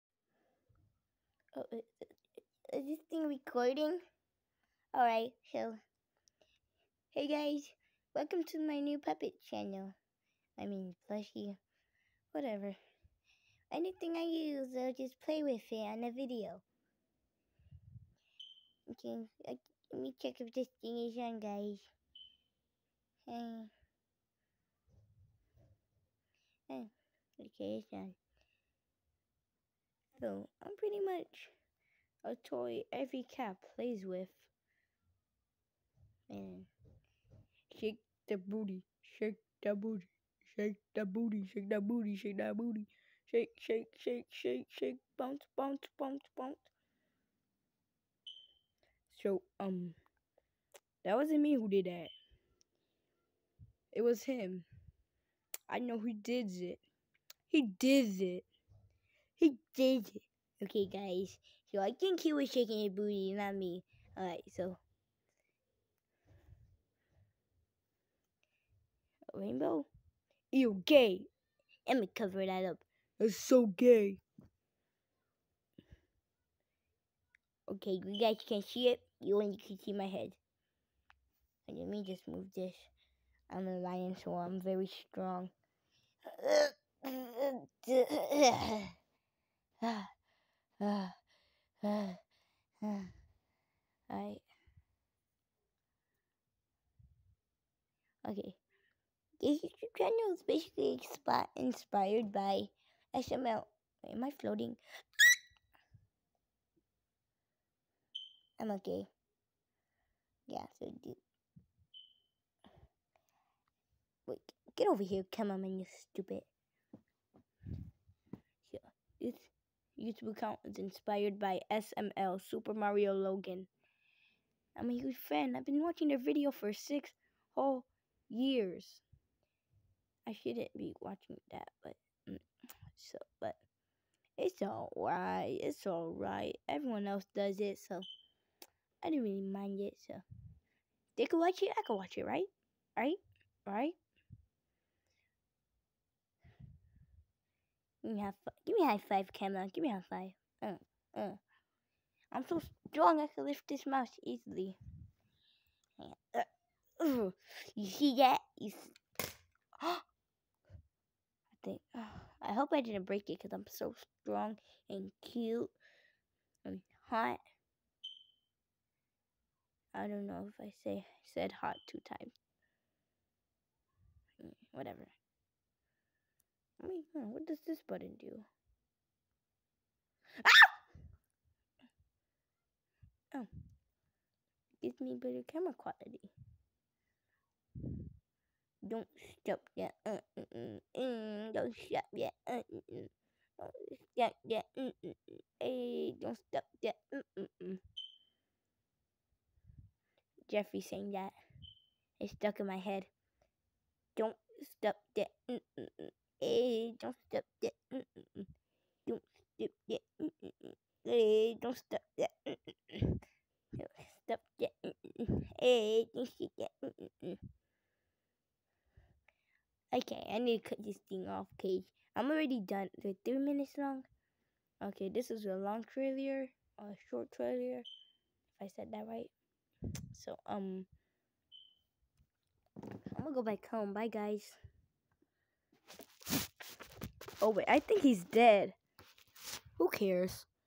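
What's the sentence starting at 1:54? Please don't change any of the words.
Wait, get over here, come on, man, you stupid.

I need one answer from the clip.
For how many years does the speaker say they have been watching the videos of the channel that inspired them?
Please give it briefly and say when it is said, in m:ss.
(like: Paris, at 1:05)
6, at 2:06.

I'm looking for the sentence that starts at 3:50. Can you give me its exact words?
So, um, I'm gonna go back home.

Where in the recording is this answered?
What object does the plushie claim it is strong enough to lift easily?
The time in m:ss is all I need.
2:33.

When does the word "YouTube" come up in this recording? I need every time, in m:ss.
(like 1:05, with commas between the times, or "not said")
1:39, 2:00.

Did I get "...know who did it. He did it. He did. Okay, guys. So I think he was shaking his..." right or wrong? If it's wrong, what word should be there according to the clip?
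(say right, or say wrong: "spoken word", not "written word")
right.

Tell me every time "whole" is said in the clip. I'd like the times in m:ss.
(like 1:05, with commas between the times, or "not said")
2:07.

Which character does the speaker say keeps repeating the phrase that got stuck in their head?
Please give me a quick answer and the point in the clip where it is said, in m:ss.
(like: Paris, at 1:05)
Jeffrey, at 3:20.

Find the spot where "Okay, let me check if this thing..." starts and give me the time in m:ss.
0:18.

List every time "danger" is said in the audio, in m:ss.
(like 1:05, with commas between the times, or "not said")
not said.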